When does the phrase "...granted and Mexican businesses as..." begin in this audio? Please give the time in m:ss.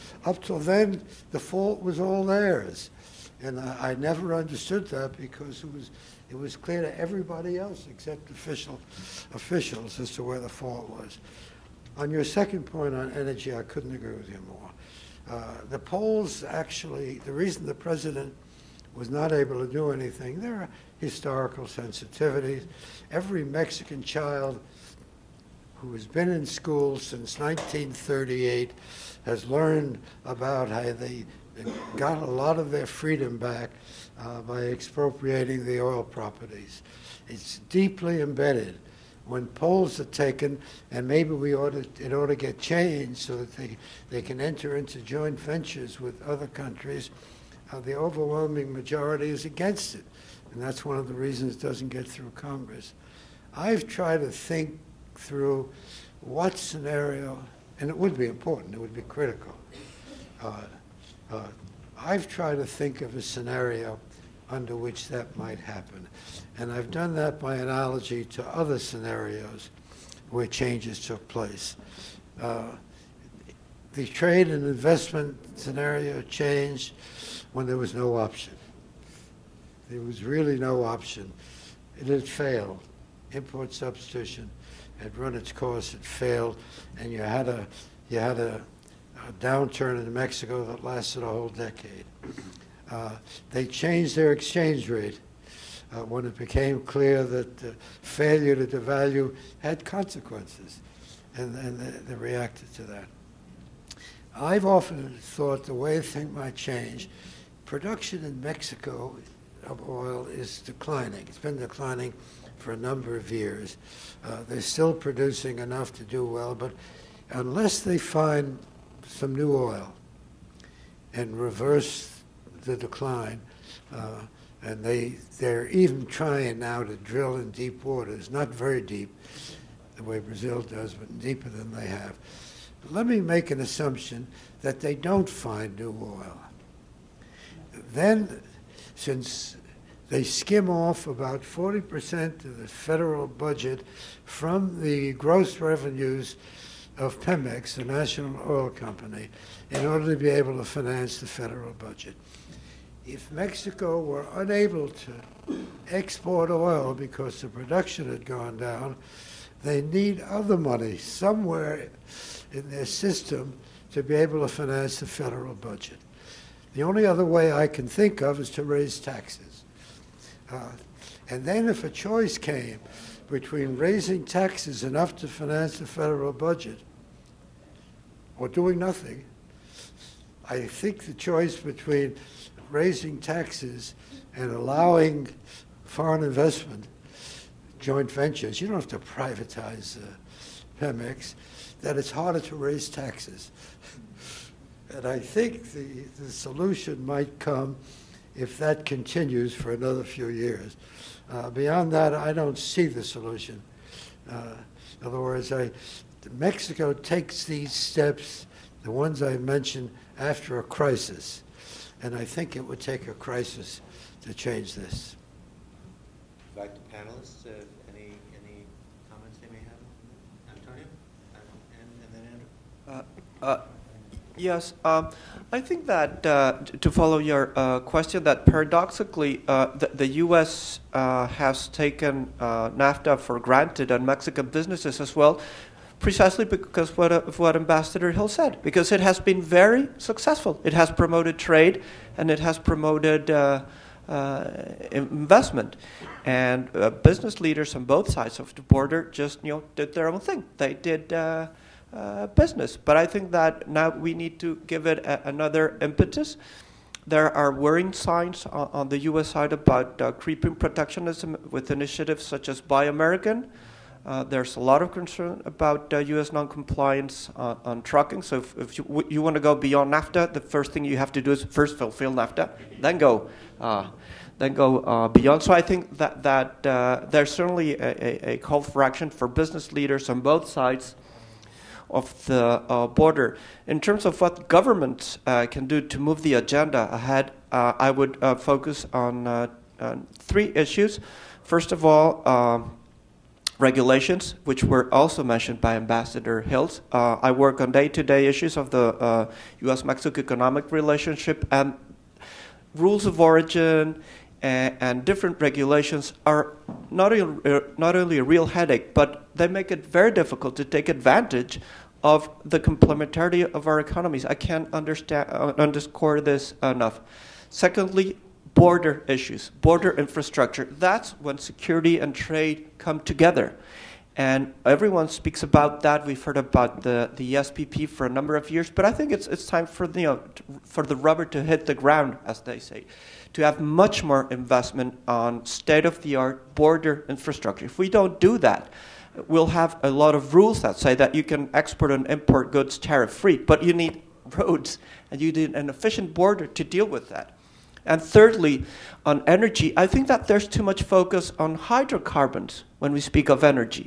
3:53.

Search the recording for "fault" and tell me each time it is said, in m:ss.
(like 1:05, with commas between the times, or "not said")
0:01, 0:10.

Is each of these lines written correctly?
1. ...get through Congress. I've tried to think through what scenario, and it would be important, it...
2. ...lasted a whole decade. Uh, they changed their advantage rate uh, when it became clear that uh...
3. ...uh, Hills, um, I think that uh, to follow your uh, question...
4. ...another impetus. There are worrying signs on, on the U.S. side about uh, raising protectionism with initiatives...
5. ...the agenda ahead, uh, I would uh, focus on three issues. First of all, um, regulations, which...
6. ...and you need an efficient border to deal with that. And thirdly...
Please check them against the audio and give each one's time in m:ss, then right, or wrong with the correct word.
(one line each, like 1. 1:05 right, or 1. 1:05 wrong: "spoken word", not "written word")
1. 0:51 right
2. 1:30 wrong: "exchange", not "advantage"
3. 3:43 wrong: "Yes", not "Hills"
4. 4:15 wrong: "creeping", not "raising"
5. 4:46 right
6. 5:45 right.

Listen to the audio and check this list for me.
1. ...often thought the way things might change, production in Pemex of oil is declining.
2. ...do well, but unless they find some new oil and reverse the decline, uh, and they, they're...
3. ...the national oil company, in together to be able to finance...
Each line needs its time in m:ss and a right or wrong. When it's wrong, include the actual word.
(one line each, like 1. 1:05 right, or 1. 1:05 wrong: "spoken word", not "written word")
1. 1:44 wrong: "Mexico", not "Pemex"
2. 1:56 right
3. 2:27 wrong: "order", not "together".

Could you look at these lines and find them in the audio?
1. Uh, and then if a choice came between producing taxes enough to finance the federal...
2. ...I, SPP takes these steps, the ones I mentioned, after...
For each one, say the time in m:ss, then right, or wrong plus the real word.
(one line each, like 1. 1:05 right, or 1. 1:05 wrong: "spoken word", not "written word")
1. 2:50 wrong: "raising", not "producing"
2. 3:25 wrong: "Mexico", not "SPP".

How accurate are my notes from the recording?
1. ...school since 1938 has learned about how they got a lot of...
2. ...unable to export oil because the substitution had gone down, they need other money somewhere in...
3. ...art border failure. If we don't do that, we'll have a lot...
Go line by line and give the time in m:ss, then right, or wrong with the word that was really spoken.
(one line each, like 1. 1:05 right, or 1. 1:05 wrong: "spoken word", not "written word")
1. 0:26 right
2. 2:34 wrong: "production", not "substitution"
3. 5:36 wrong: "infrastructure", not "failure".